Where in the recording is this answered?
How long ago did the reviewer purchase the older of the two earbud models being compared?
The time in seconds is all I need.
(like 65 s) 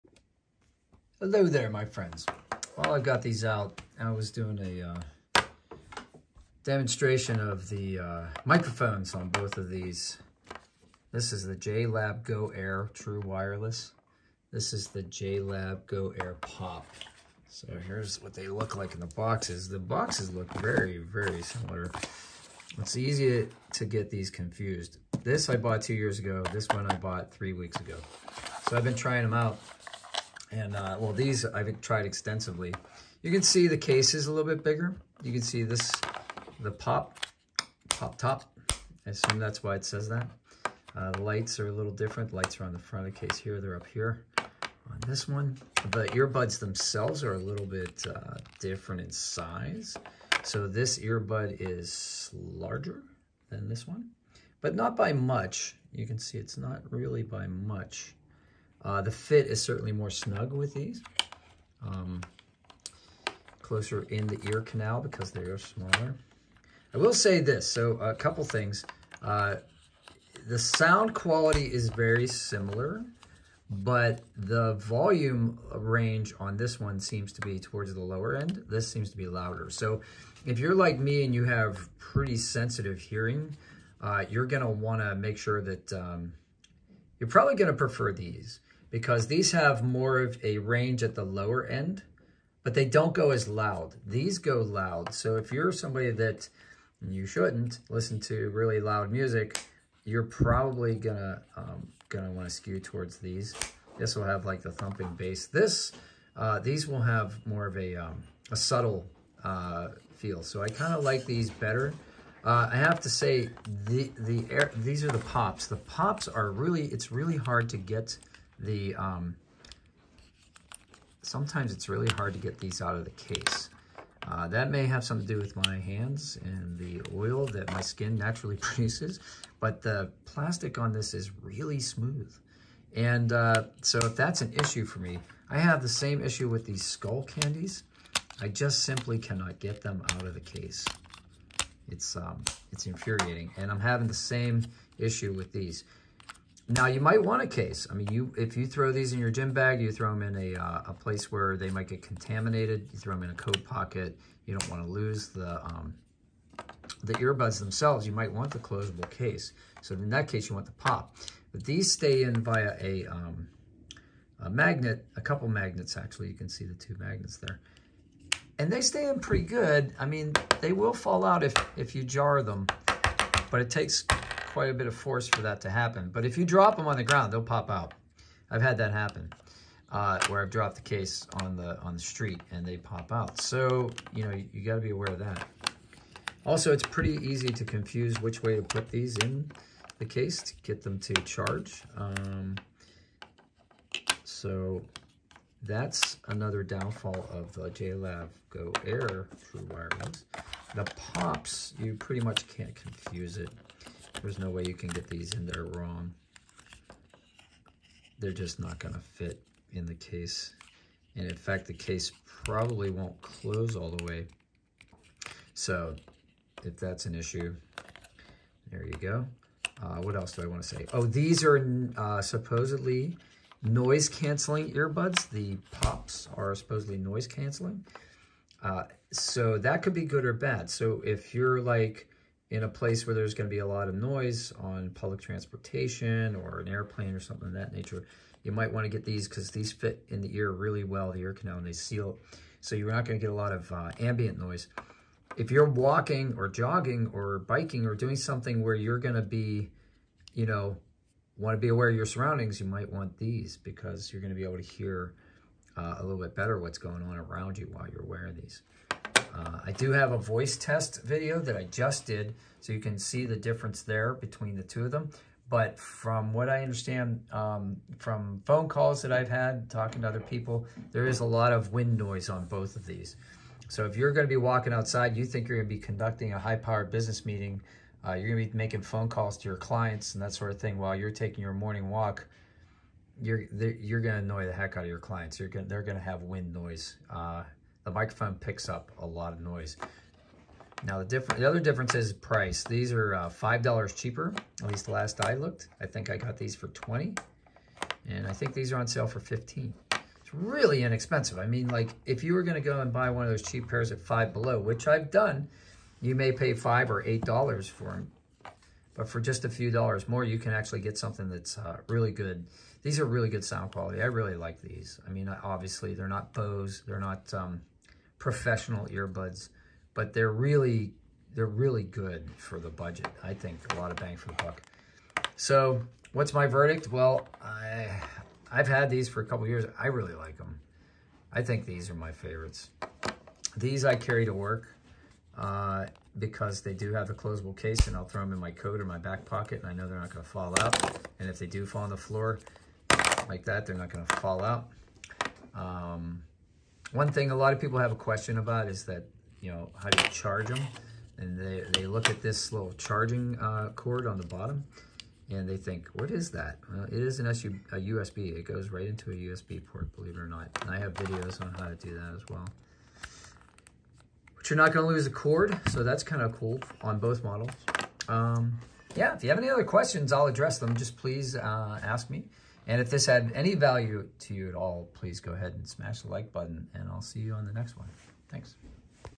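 25 s.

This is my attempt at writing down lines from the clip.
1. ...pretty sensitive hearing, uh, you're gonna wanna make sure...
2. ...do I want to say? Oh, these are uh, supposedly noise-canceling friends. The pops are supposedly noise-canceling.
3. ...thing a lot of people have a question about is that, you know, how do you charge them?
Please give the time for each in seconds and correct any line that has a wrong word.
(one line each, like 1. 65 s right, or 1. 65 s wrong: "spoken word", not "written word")
1. 81 s right
2. 220 s wrong: "earbuds", not "friends"
3. 347 s right.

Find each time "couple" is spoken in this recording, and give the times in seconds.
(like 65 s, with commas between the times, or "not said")
68 s, 165 s, 329 s.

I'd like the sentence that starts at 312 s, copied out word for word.
These are really good sound quality.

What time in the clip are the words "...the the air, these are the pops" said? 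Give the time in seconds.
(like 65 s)
113 s.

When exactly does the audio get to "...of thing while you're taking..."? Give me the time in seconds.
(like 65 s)
280 s.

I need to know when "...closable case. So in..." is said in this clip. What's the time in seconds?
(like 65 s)
158 s.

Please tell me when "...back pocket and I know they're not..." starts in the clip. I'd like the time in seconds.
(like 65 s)
338 s.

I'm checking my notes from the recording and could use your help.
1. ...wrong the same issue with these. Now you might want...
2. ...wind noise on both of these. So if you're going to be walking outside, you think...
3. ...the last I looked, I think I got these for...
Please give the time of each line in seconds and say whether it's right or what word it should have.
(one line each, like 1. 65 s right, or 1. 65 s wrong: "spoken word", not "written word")
1. 143 s wrong: "having", not "wrong"
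2. 271 s right
3. 294 s right.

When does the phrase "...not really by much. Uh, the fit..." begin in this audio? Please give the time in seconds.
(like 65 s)
56 s.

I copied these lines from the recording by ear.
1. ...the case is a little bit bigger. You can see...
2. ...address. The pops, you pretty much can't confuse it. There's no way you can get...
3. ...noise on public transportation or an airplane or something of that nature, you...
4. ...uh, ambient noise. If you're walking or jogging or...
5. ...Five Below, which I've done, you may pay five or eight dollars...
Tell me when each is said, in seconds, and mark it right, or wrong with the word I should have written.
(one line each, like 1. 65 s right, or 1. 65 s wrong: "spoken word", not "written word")
1. 33 s right
2. 199 s wrong: "wireless", not "address"
3. 233 s right
4. 243 s right
5. 304 s right.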